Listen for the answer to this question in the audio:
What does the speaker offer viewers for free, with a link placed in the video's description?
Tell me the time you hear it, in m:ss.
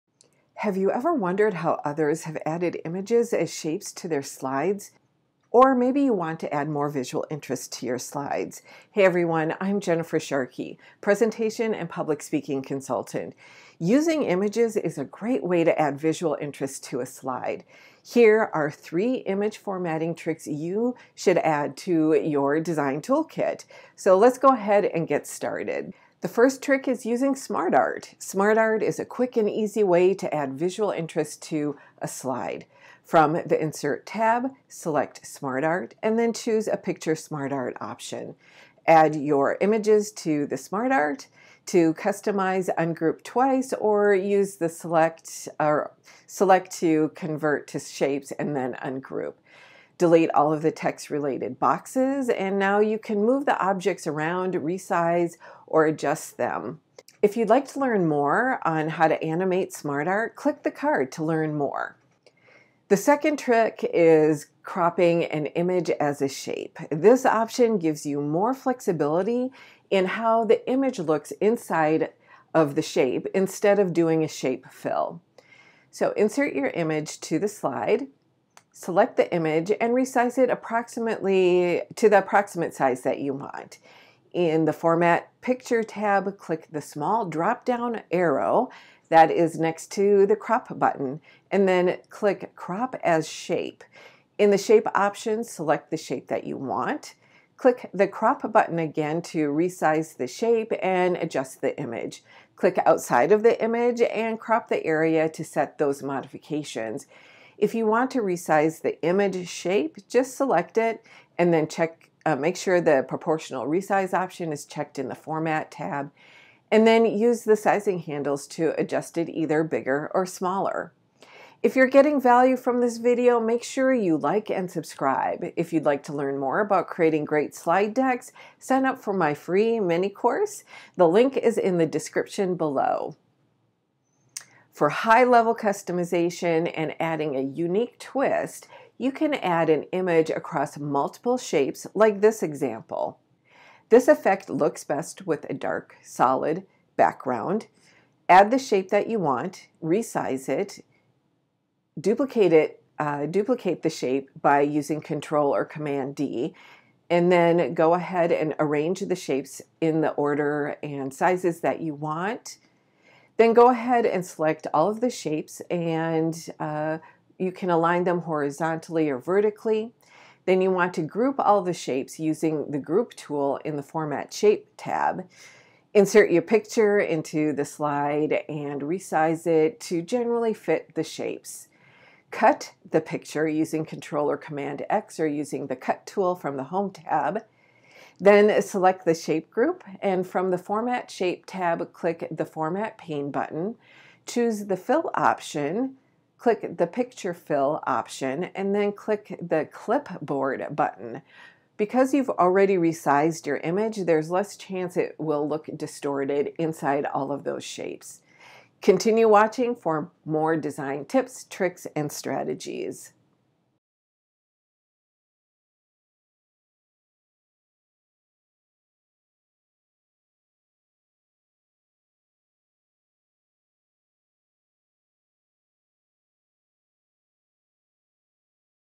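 2:09.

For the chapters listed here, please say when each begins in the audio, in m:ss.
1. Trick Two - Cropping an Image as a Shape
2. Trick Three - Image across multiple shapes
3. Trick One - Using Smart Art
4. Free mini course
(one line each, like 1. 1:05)
1. 1:03
2. 2:15
3. 0:26
4. 2:05.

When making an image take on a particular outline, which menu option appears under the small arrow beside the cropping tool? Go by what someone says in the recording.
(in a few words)
Crop as Shape.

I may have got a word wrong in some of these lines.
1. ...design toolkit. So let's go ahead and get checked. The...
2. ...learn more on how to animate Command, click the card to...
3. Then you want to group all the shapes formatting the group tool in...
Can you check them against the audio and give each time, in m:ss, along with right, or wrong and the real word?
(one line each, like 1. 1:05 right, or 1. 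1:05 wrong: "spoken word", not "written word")
1. 0:22 wrong: "started", not "checked"
2. 0:57 wrong: "SmartArt", not "Command"
3. 2:50 wrong: "using", not "formatting".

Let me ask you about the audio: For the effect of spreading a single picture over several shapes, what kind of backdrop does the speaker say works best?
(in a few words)
dark, solid background.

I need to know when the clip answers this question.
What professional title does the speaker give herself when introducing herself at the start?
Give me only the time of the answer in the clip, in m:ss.
0:11.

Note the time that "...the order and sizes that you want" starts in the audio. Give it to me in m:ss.
2:39.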